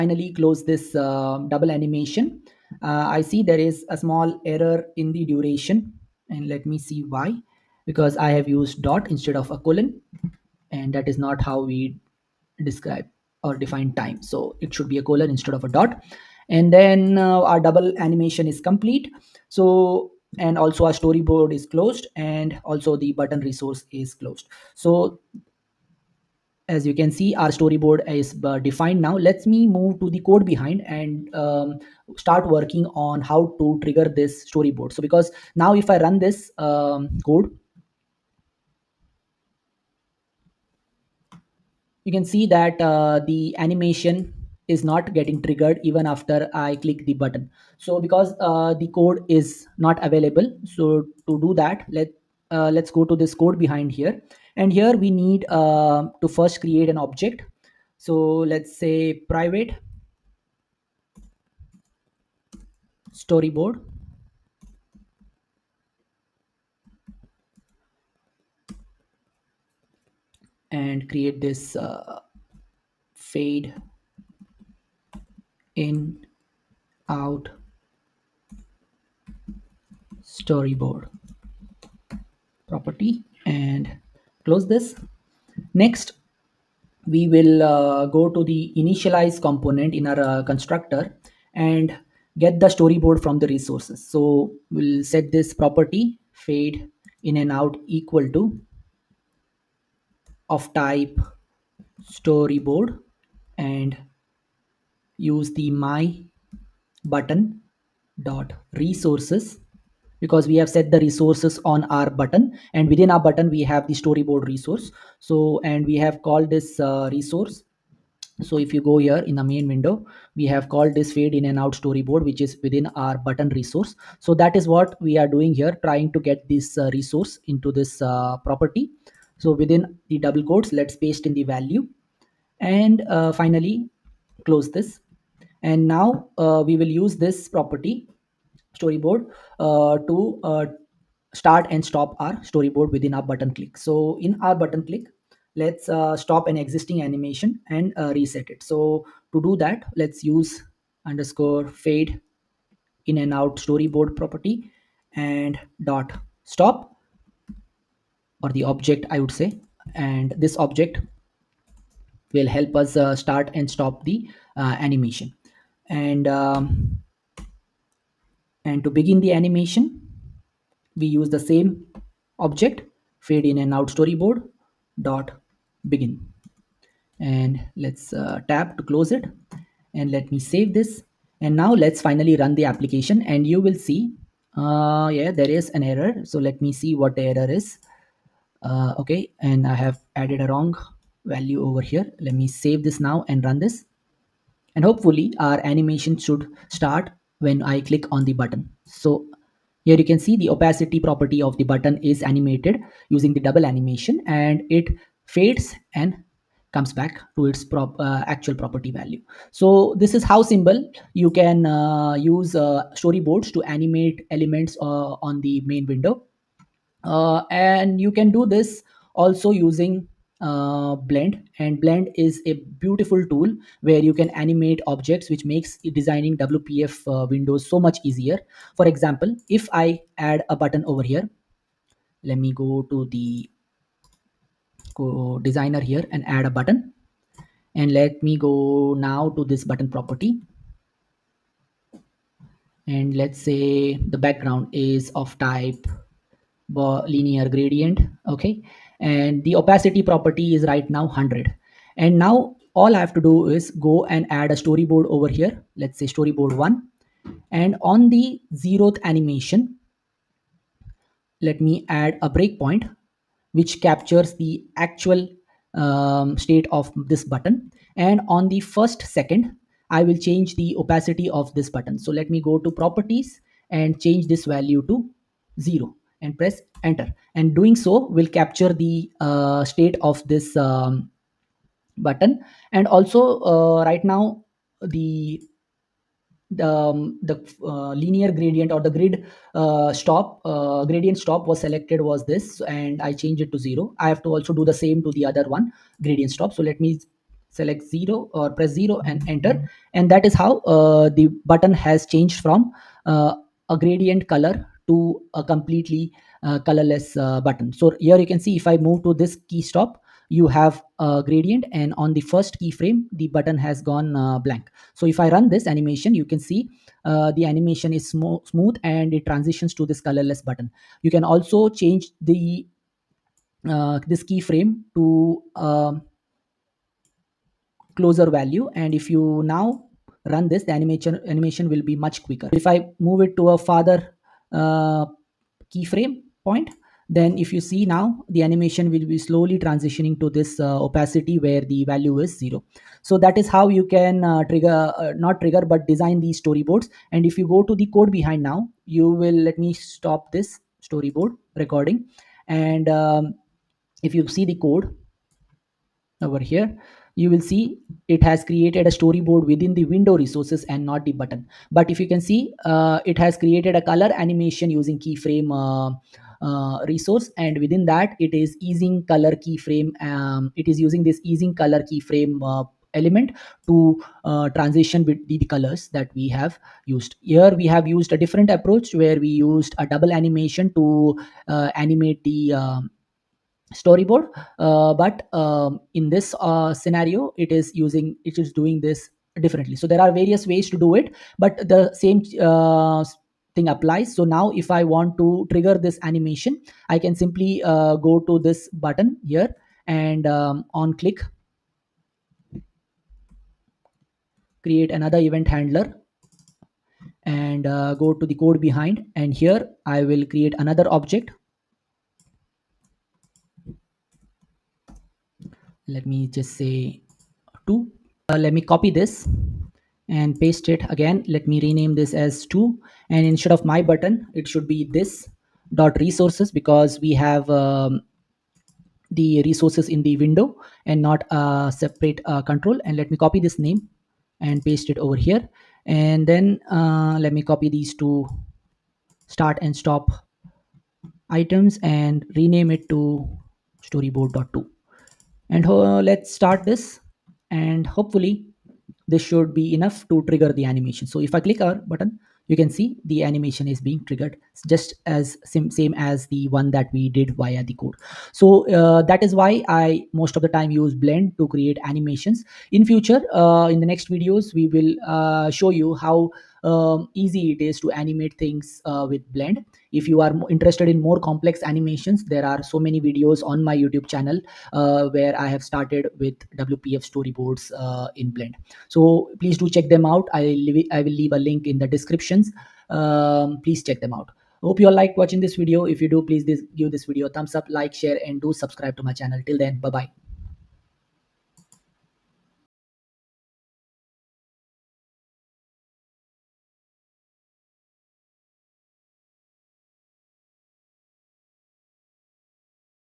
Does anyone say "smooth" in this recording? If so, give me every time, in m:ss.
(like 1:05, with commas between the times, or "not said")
5:18.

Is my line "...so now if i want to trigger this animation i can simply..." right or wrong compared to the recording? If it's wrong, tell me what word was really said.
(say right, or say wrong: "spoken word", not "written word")
right.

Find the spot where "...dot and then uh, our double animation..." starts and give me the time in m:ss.
0:15.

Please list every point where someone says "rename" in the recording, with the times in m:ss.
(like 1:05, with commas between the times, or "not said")
7:01, 7:22.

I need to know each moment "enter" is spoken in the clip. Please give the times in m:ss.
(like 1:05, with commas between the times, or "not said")
4:36, 4:59.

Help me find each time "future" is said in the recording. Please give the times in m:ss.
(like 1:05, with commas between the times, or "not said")
7:42.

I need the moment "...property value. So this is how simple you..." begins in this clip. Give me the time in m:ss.
3:28.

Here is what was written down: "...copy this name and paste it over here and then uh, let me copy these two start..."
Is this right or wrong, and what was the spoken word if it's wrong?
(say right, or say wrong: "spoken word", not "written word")
right.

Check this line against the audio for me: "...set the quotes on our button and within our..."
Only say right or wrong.
wrong.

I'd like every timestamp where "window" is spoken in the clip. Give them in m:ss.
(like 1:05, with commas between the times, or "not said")
1:59, 3:35, 3:47, 5:59, 7:10.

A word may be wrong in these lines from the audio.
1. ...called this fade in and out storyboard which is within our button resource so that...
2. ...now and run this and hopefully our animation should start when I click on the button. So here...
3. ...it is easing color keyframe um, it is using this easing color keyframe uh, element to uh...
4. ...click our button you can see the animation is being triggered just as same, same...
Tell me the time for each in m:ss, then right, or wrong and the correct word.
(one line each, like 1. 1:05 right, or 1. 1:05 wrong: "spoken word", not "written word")
1. 2:00 right
2. 3:12 right
3. 6:08 right
4. 7:31 right.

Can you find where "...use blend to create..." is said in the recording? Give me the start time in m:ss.
7:40.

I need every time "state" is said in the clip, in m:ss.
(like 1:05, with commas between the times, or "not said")
4:26, 4:39.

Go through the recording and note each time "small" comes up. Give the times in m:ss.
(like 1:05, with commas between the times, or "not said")
0:03.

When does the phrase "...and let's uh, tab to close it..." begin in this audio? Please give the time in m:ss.
2:57.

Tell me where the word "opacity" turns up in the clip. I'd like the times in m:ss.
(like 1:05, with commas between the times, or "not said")
3:20, 4:09, 4:30, 5:40.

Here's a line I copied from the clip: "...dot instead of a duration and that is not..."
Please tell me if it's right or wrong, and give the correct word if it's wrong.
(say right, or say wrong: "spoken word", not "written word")
wrong: "colon", not "duration".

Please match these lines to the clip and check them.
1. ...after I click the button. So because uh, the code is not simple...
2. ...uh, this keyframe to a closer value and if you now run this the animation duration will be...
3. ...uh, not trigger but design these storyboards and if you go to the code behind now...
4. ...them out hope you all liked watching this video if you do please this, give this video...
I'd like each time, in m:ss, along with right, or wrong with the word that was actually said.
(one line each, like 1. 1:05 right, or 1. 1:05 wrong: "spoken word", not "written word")
1. 0:46 wrong: "available", not "simple"
2. 5:23 wrong: "animation", not "duration"
3. 5:44 right
4. 8:03 right.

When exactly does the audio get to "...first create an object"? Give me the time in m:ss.
0:56.